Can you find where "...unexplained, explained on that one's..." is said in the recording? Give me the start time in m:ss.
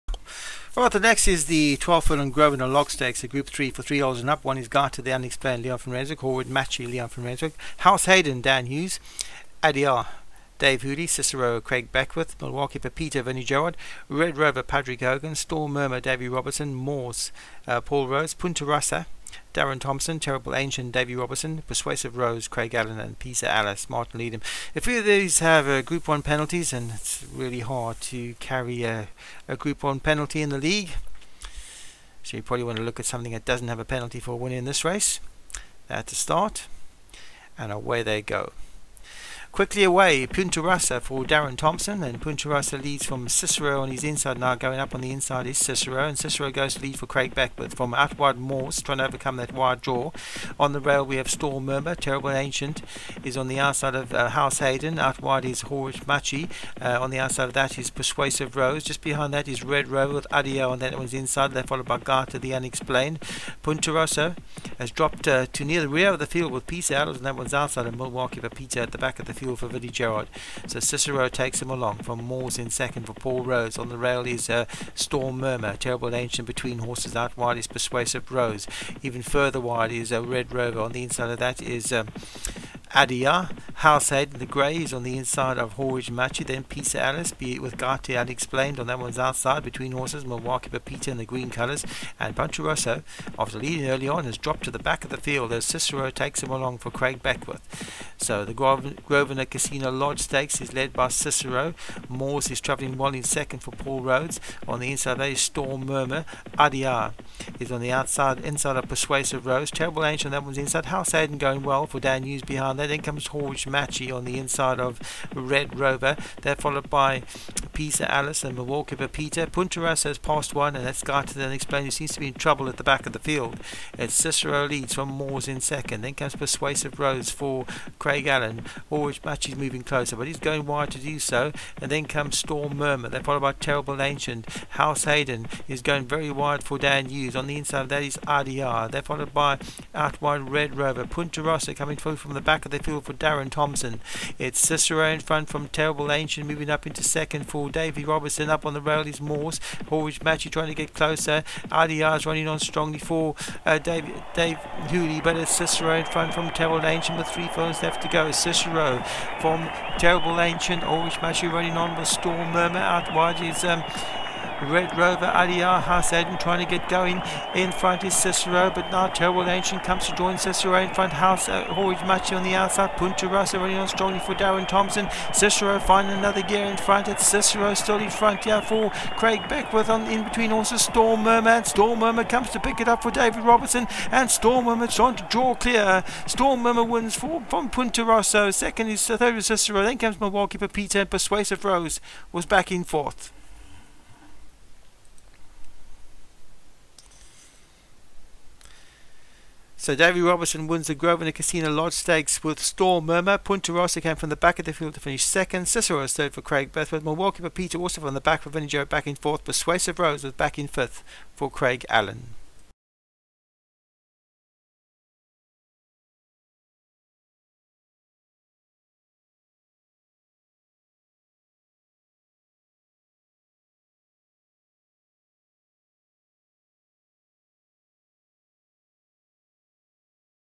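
1:28.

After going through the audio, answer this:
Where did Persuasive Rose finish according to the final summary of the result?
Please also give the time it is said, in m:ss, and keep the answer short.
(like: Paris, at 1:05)
Fifth, at 3:29.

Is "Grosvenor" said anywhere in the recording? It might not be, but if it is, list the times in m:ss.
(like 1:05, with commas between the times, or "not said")
1:38, 3:20.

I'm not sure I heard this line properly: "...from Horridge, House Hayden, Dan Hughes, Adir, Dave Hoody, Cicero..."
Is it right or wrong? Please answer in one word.
wrong.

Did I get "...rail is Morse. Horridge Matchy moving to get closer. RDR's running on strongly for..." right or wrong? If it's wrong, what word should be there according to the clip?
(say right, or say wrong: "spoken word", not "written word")
wrong: "trying", not "moving".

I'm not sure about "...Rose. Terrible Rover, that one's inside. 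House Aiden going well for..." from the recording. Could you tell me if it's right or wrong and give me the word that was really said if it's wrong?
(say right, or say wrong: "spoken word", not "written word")
wrong: "Ancient", not "Rover".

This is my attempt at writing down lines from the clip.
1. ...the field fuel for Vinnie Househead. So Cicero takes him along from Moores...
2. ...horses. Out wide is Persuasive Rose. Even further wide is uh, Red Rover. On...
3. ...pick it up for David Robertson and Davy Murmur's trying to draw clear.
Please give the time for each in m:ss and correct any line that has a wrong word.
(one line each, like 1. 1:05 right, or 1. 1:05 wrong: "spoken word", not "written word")
1. 1:09 wrong: "Gerard", not "Househead"
2. 1:16 right
3. 3:02 wrong: "Storm", not "Davy".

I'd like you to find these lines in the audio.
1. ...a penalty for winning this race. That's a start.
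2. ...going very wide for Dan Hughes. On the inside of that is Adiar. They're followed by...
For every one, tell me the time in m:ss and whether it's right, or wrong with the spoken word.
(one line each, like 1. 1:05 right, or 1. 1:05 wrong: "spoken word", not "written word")
1. 0:33 right
2. 2:15 right.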